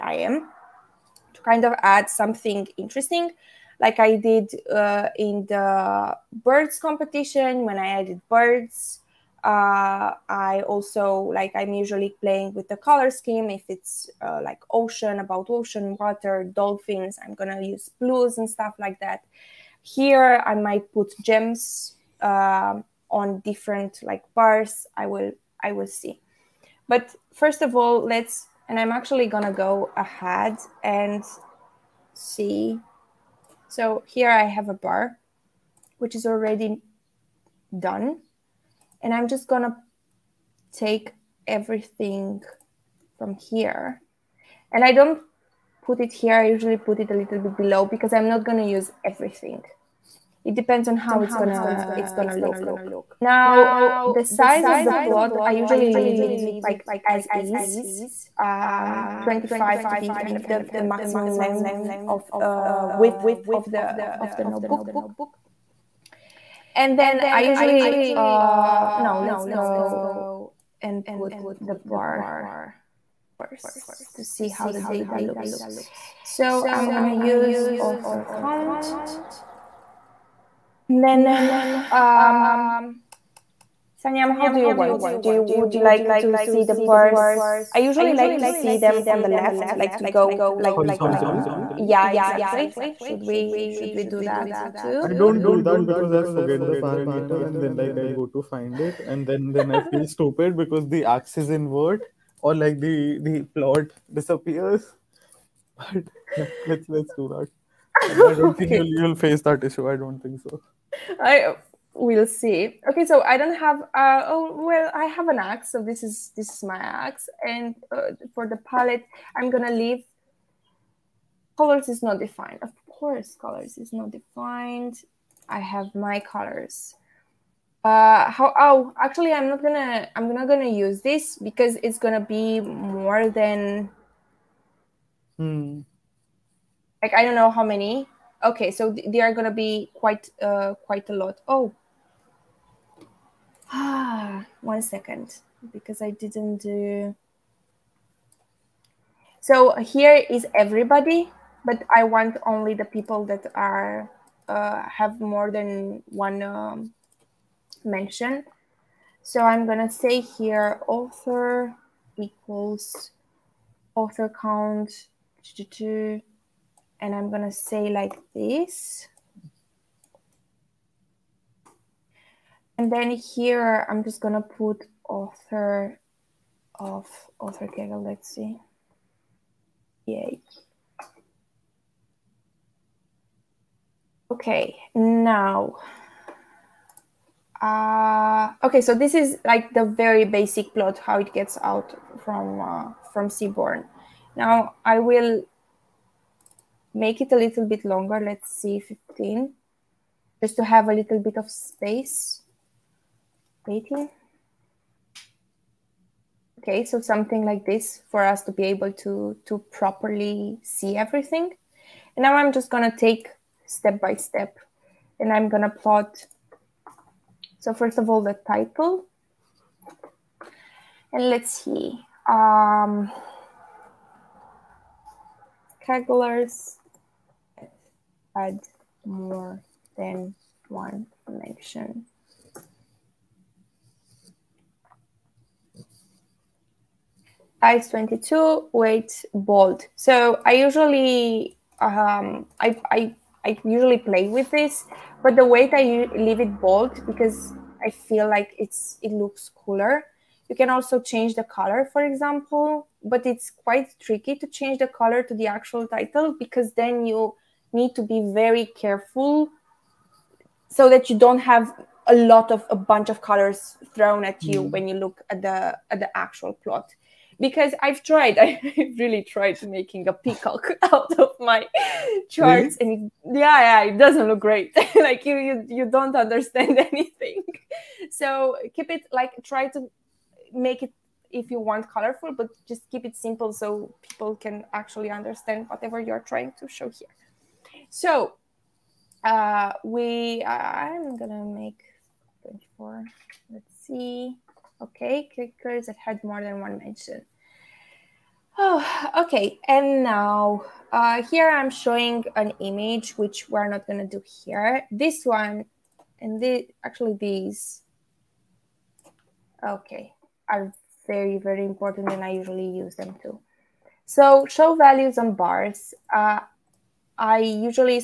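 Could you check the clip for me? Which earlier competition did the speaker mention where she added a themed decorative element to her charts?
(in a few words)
Birds competition.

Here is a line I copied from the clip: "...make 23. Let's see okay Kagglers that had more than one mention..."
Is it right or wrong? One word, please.
wrong.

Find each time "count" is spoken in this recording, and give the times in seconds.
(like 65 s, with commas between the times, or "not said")
78 s, 164 s.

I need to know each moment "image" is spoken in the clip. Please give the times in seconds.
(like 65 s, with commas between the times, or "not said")
302 s.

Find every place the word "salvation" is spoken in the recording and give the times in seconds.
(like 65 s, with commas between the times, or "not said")
not said.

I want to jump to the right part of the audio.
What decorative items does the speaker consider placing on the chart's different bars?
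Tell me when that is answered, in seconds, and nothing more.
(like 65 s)
21 s.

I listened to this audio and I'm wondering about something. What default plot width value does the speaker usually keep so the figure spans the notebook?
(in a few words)
25.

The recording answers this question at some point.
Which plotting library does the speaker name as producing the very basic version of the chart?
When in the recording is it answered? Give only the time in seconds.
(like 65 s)
193 s.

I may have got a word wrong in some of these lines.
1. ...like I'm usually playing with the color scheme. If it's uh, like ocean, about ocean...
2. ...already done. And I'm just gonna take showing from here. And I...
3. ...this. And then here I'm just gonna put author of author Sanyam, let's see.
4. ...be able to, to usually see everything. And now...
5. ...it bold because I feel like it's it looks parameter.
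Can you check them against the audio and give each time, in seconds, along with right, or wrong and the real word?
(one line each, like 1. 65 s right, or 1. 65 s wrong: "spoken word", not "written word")
1. 11 s right
2. 36 s wrong: "everything", not "showing"
3. 168 s wrong: "Kaggle", not "Sanyam"
4. 208 s wrong: "properly", not "usually"
5. 246 s wrong: "cooler", not "parameter".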